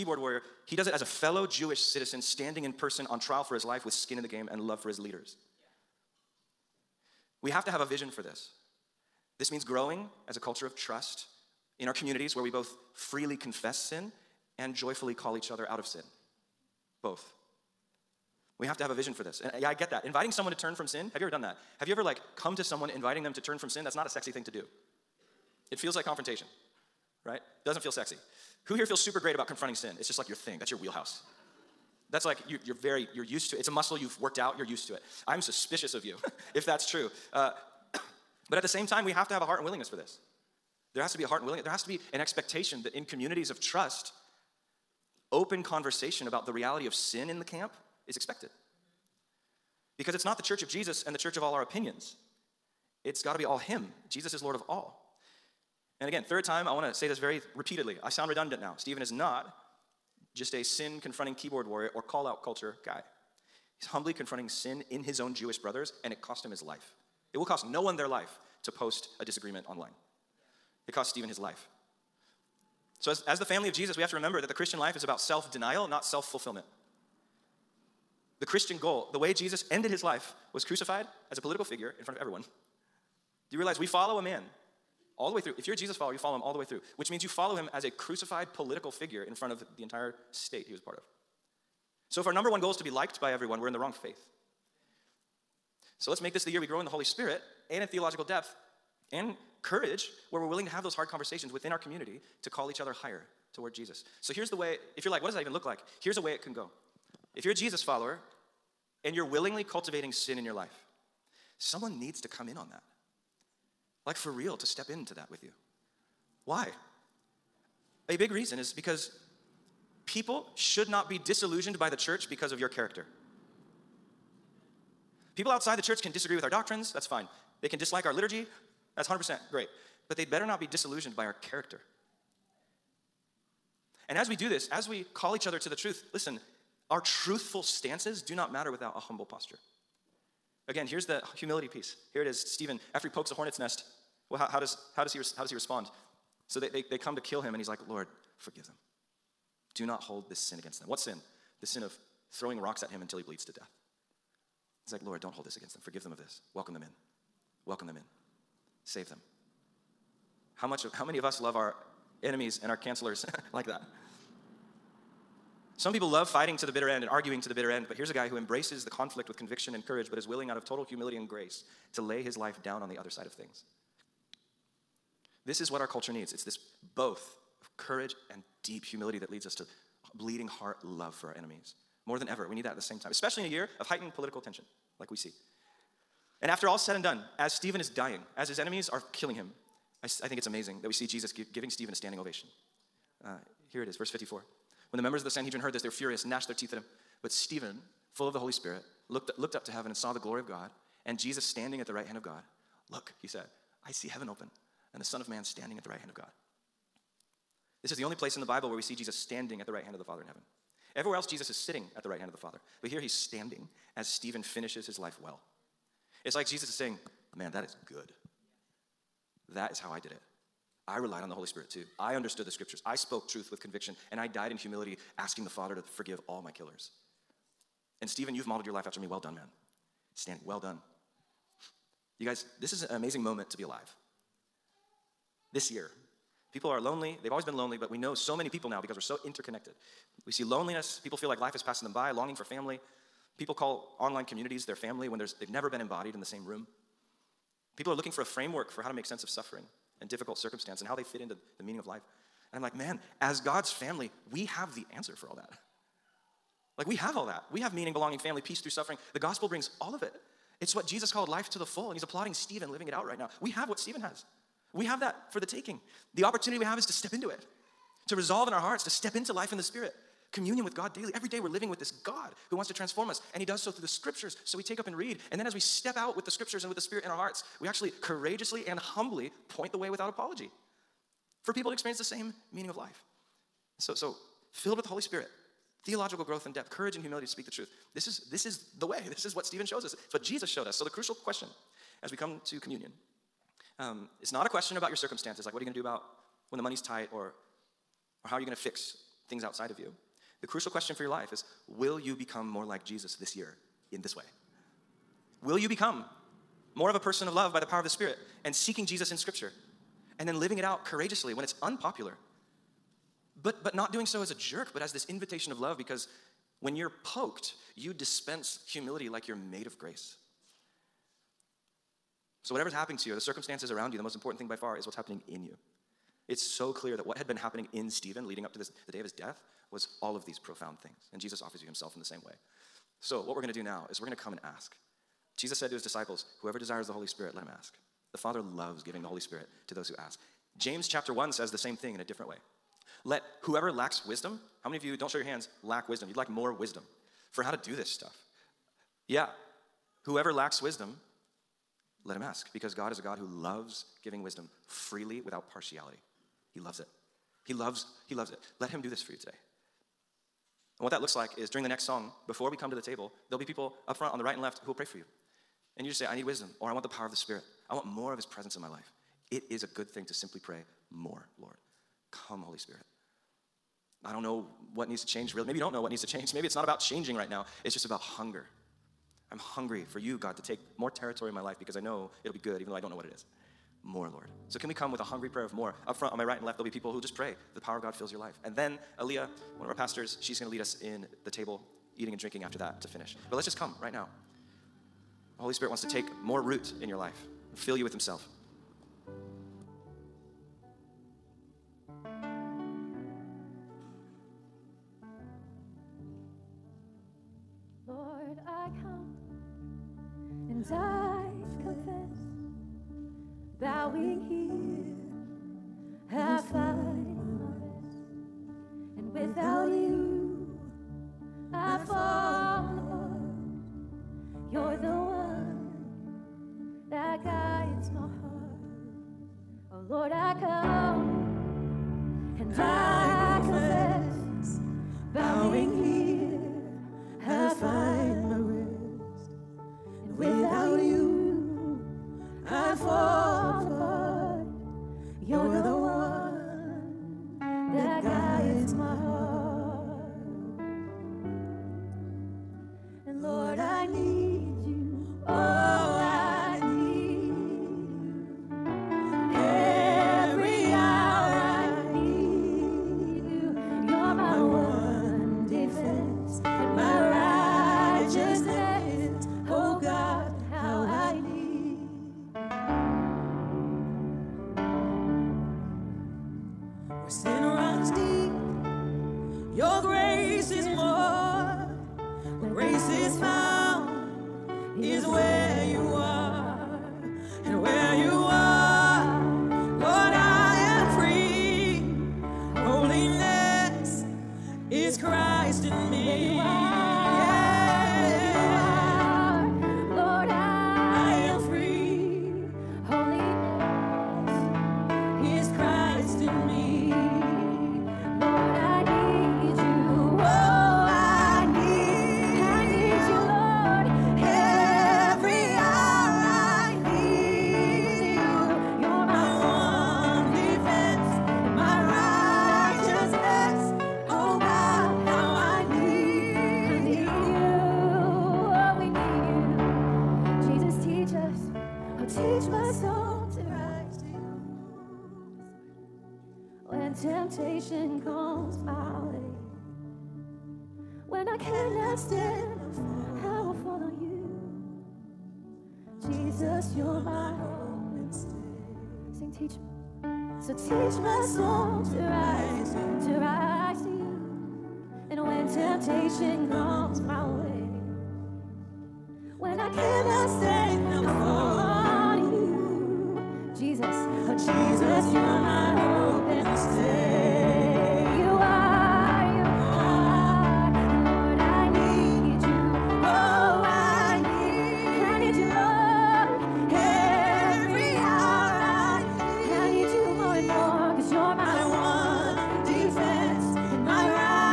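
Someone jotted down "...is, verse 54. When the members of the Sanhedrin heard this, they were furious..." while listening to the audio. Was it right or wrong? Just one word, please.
right.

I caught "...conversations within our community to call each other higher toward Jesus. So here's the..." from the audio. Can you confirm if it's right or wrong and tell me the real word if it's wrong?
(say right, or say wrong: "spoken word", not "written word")
right.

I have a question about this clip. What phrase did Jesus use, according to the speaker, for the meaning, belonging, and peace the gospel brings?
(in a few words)
Life to the full.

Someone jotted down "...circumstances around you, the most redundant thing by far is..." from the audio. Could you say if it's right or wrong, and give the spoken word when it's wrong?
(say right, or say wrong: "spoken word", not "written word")
wrong: "important", not "redundant".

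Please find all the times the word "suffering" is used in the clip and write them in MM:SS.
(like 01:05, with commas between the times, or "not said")
04:09, 04:18.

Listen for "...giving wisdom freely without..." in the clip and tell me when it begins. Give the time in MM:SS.
05:54.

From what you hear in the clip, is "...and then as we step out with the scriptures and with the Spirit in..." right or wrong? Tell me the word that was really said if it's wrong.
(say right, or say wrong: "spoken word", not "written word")
right.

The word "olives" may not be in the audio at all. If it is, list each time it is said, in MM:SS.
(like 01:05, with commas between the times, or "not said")
not said.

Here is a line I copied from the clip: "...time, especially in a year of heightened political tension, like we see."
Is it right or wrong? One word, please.
right.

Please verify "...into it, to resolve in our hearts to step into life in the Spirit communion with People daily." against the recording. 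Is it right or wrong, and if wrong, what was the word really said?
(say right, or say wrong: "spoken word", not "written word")
wrong: "God", not "People".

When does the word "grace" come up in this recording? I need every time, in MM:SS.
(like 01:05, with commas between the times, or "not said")
02:51, 05:19.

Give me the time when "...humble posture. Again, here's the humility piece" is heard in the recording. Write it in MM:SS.
02:18.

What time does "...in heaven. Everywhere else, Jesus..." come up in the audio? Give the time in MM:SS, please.
03:30.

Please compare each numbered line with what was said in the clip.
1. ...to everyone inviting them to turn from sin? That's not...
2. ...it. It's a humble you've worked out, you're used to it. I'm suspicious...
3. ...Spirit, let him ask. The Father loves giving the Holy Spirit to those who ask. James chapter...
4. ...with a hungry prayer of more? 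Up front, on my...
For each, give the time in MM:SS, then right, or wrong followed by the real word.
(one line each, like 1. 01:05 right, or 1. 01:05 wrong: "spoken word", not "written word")
1. 00:22 wrong: "someone", not "everyone"
2. 00:33 wrong: "muscle", not "humble"
3. 05:37 right
4. 06:24 right.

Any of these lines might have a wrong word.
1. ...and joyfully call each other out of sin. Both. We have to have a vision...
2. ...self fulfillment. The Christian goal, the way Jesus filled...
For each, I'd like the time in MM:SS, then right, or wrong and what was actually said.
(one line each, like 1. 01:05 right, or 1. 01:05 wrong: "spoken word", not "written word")
1. 00:14 right
2. 01:16 wrong: "ended", not "filled".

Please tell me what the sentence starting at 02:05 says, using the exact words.
People outside the church can disagree with our doctrines, that's fine.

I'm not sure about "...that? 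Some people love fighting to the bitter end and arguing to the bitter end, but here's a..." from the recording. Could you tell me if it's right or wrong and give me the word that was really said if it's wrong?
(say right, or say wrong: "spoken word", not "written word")
right.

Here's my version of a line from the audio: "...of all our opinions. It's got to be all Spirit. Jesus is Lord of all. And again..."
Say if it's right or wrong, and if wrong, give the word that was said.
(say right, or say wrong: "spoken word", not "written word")
wrong: "Him", not "Spirit".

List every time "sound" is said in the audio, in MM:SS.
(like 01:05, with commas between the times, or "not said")
00:58.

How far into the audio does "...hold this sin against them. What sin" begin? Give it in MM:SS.
02:30.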